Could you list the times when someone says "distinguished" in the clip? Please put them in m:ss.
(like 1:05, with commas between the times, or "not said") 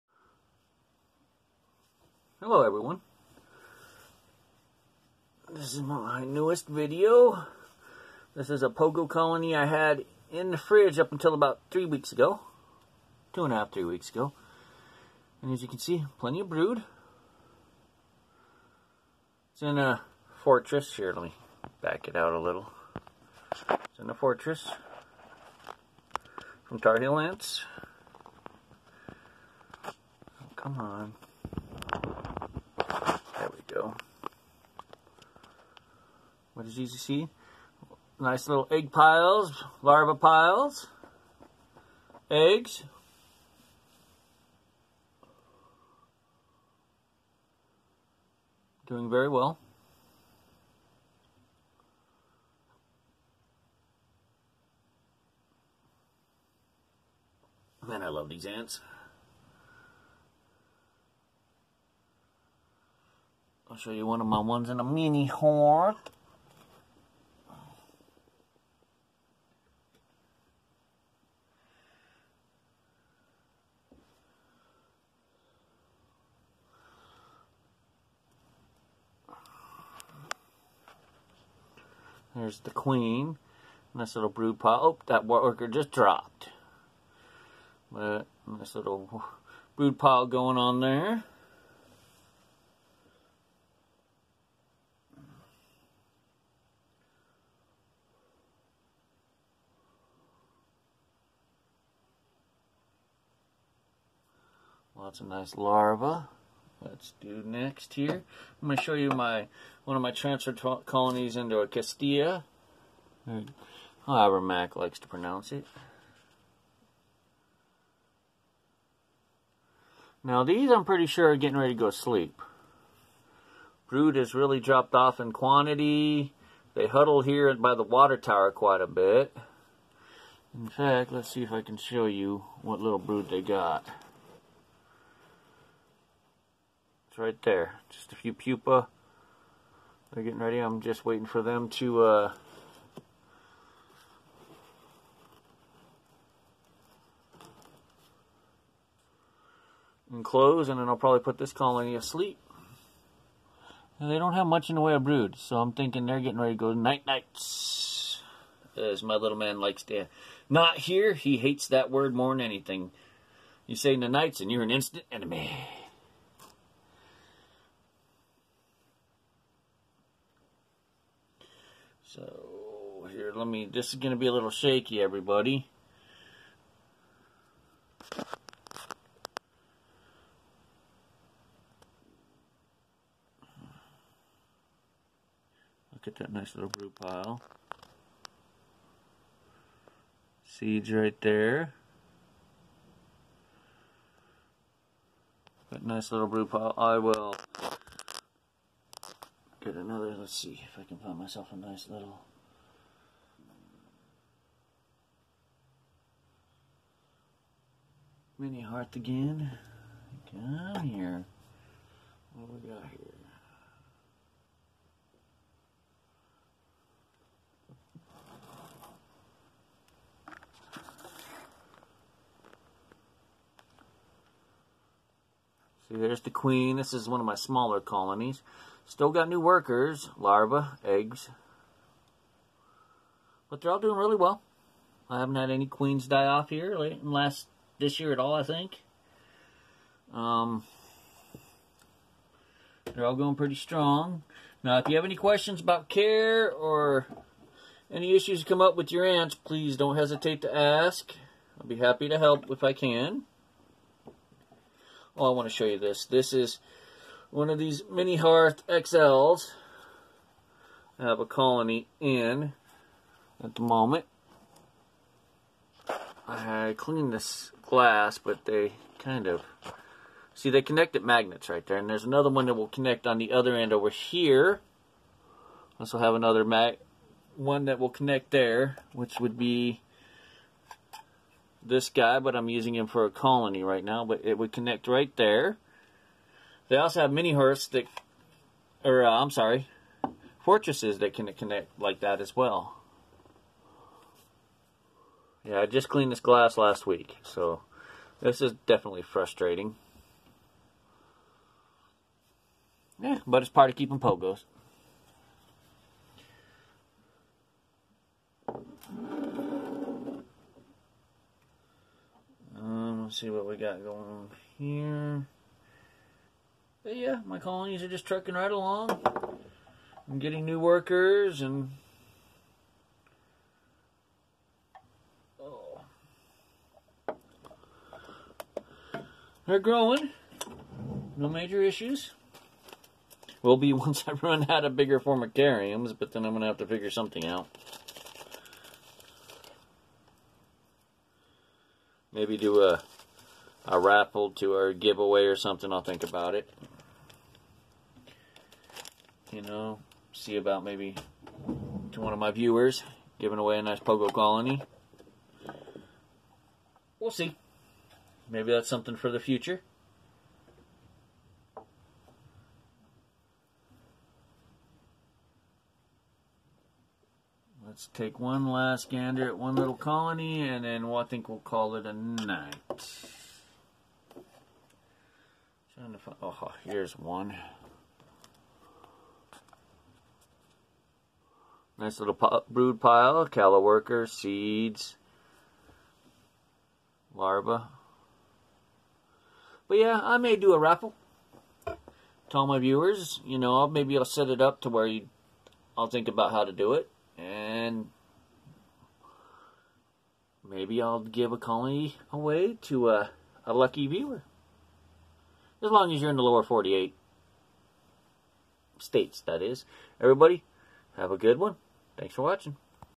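not said.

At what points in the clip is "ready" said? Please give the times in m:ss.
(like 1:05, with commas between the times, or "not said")
2:01, 2:20, 2:36.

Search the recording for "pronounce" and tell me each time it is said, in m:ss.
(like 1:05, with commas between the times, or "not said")
1:55.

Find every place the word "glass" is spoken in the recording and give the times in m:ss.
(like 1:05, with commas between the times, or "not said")
4:27, 4:56.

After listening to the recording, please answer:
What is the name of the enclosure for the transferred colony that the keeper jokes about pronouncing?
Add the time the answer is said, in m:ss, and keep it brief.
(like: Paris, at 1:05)
Castilla, at 1:51.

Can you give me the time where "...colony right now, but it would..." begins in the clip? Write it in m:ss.
4:43.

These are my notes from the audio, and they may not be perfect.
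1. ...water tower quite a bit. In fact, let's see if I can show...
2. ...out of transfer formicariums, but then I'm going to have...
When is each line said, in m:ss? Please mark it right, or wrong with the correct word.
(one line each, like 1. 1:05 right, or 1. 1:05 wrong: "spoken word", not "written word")
1. 2:07 right
2. 5:34 wrong: "bigger", not "transfer".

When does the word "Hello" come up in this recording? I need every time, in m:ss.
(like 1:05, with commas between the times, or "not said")
0:02.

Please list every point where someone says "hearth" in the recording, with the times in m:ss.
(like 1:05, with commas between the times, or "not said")
3:28, 4:18, 4:47.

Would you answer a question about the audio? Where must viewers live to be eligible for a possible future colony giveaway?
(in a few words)
Lower 48 states.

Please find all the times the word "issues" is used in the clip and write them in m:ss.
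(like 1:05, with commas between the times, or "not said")
4:08, 5:31.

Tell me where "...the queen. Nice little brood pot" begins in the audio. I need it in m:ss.
1:22.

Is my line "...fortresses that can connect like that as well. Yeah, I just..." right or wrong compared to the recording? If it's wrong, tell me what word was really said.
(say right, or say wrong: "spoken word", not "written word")
right.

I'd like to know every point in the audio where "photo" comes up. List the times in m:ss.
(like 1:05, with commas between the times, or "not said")
not said.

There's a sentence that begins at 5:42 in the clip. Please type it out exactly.
Maybe do a, a raffle to our giveaway or something.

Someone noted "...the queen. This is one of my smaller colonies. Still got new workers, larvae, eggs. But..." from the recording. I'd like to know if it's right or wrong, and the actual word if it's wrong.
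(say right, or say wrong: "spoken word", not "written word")
right.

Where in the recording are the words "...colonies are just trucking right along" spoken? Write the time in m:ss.
5:17.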